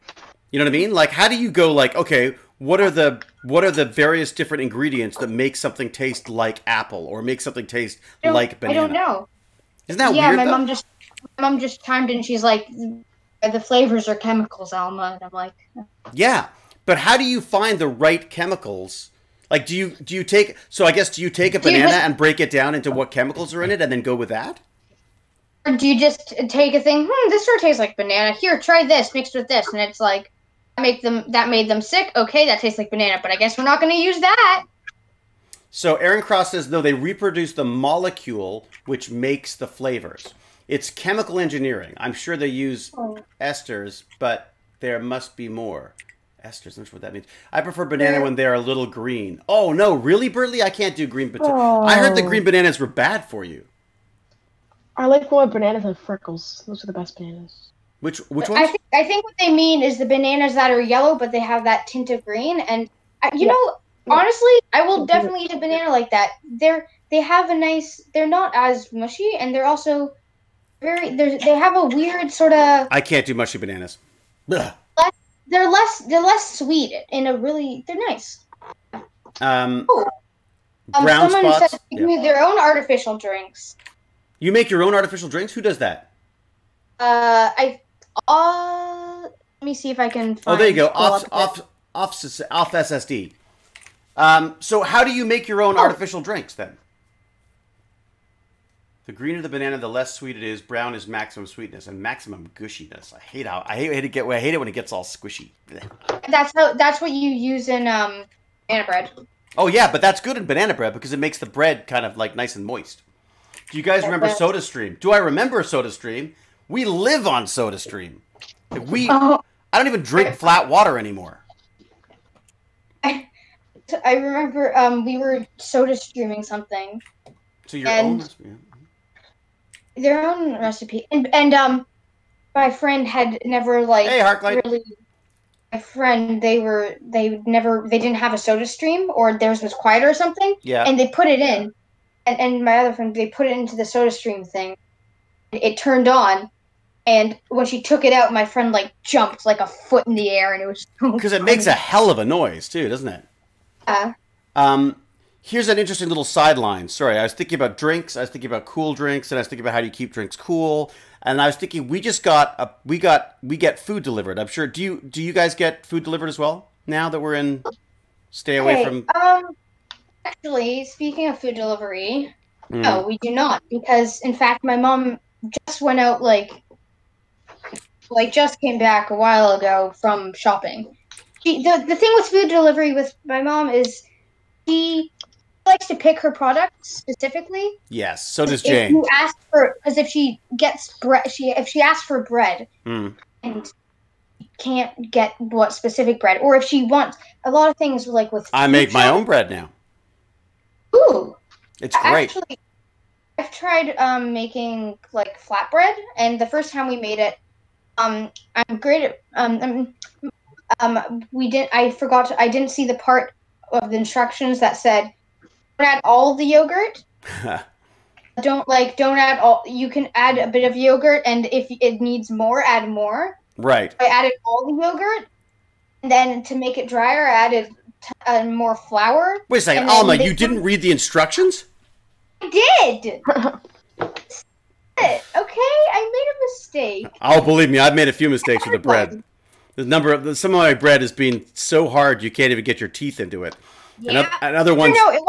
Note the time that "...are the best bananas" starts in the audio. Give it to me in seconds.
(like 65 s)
56 s.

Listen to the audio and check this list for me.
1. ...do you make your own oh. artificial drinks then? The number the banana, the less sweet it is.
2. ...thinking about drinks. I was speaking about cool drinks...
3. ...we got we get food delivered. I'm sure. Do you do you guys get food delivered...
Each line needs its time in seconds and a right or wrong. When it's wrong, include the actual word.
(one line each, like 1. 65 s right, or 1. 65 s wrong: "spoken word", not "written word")
1. 95 s wrong: "greener", not "number"
2. 157 s wrong: "thinking", not "speaking"
3. 162 s right.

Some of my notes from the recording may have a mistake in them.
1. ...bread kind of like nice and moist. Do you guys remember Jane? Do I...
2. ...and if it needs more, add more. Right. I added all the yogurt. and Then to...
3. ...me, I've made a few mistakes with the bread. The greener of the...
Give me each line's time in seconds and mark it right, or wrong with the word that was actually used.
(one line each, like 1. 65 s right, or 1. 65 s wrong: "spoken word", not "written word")
1. 111 s wrong: "SodaStream", not "Jane"
2. 221 s right
3. 237 s wrong: "number", not "greener".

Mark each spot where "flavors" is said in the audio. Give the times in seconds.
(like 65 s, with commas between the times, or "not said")
13 s, 39 s.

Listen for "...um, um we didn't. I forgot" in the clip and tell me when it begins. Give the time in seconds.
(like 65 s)
209 s.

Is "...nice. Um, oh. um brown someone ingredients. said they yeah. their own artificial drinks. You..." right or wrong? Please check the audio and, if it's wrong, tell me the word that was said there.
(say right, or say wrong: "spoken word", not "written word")
wrong: "spots", not "ingredients".